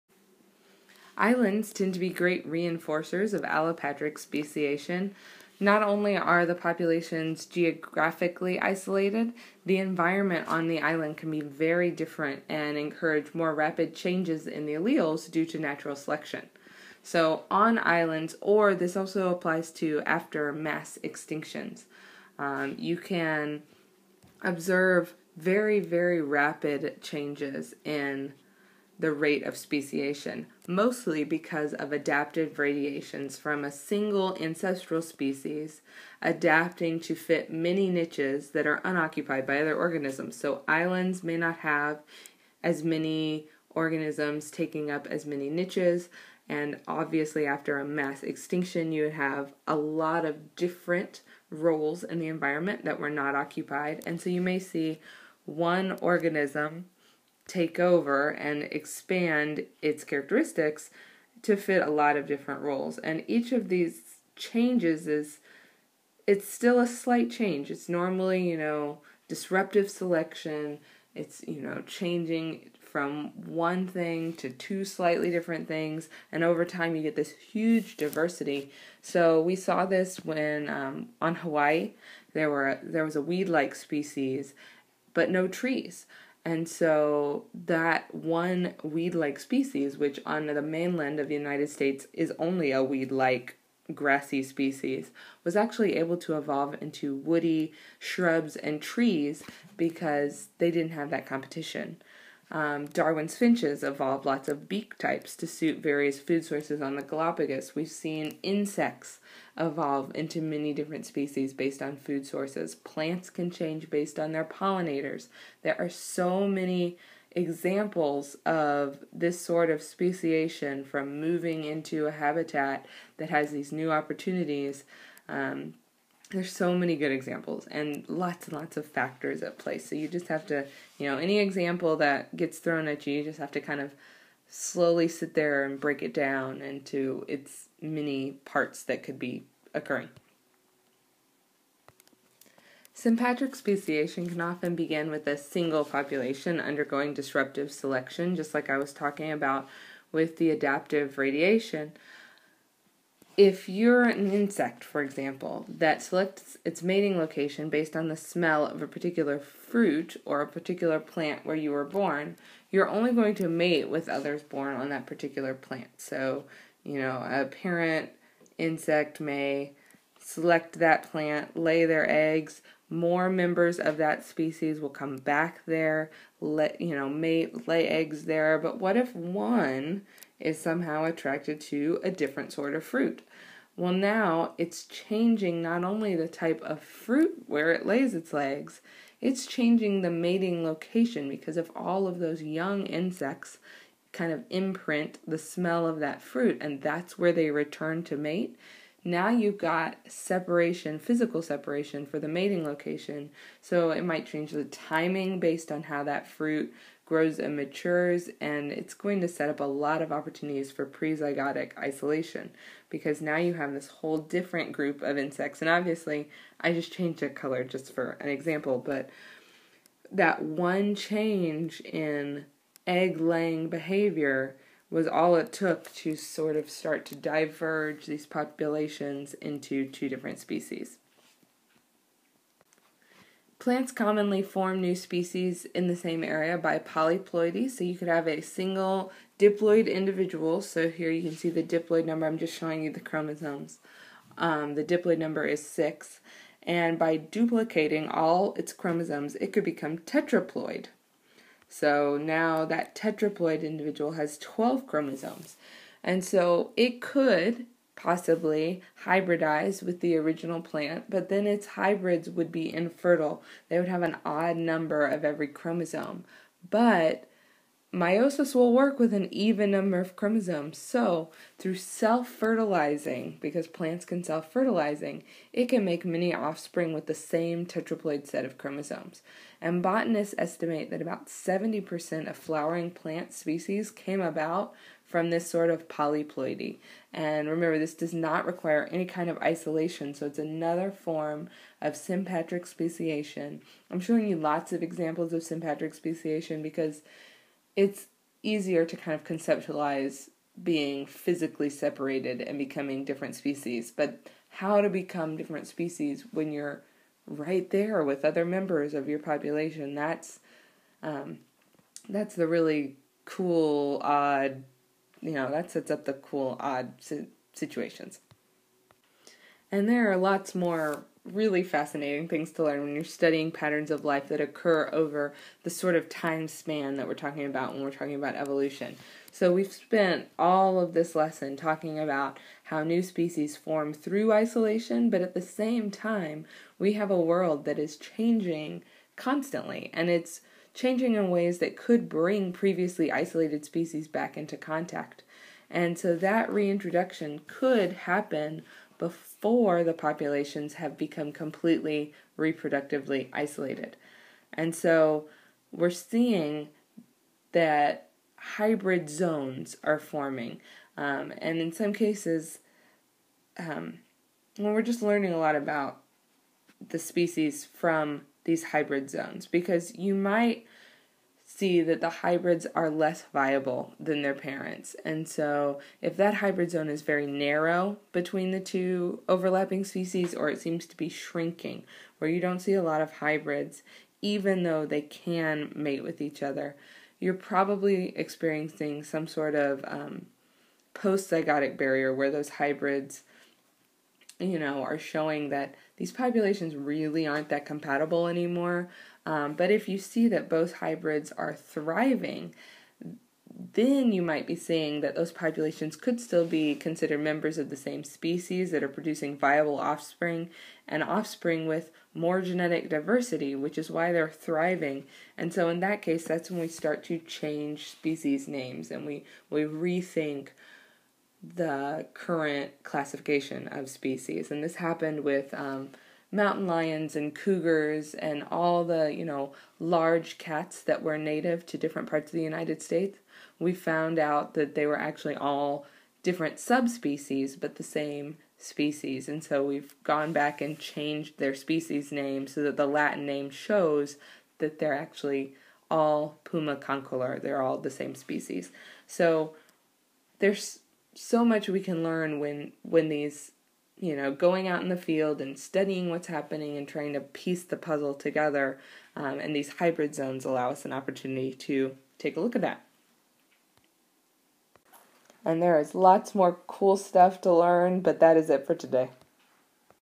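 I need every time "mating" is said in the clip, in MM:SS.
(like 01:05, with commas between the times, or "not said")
02:36, 03:10, 03:22.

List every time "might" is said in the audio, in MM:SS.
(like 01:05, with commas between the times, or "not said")
03:24, 06:10, 06:44.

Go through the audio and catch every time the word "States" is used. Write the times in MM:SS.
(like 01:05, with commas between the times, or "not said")
01:31, 07:12.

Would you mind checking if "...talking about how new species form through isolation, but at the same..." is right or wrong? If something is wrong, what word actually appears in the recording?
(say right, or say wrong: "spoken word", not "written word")
right.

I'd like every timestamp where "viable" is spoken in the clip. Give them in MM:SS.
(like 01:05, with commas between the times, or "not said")
06:13, 06:49.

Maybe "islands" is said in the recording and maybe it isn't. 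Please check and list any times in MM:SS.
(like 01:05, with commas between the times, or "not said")
00:01, 00:10, 00:17, 00:40.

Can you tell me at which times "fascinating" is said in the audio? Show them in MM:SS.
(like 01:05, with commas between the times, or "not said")
05:21.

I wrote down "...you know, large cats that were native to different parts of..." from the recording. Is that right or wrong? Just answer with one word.
right.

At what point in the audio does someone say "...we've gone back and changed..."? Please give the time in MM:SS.
07:19.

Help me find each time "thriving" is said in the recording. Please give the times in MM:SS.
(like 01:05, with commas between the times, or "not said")
06:41, 06:54.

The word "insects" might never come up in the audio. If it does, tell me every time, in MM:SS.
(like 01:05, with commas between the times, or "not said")
01:48, 02:34, 02:48, 03:12, 03:35.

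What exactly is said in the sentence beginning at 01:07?
It's normally, you know, disruptive selection.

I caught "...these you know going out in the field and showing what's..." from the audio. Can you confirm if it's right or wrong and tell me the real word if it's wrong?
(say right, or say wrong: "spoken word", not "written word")
wrong: "studying", not "showing".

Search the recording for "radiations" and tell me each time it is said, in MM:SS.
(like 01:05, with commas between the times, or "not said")
00:32, 02:31.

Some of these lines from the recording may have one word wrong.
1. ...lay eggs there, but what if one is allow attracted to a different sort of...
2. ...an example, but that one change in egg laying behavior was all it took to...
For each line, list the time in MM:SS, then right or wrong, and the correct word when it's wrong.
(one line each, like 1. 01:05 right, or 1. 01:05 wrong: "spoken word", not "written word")
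1. 02:57 wrong: "somehow", not "allow"
2. 03:38 right.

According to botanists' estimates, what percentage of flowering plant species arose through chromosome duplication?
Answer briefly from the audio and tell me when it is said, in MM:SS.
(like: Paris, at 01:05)
70%, at 04:41.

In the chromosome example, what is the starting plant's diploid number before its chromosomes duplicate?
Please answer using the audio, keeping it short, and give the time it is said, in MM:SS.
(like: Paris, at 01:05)
6, at 04:05.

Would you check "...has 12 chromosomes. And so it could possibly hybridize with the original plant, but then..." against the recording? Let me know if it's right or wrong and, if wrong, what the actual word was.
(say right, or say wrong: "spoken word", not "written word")
right.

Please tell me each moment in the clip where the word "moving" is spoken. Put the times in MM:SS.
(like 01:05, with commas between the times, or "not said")
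02:01.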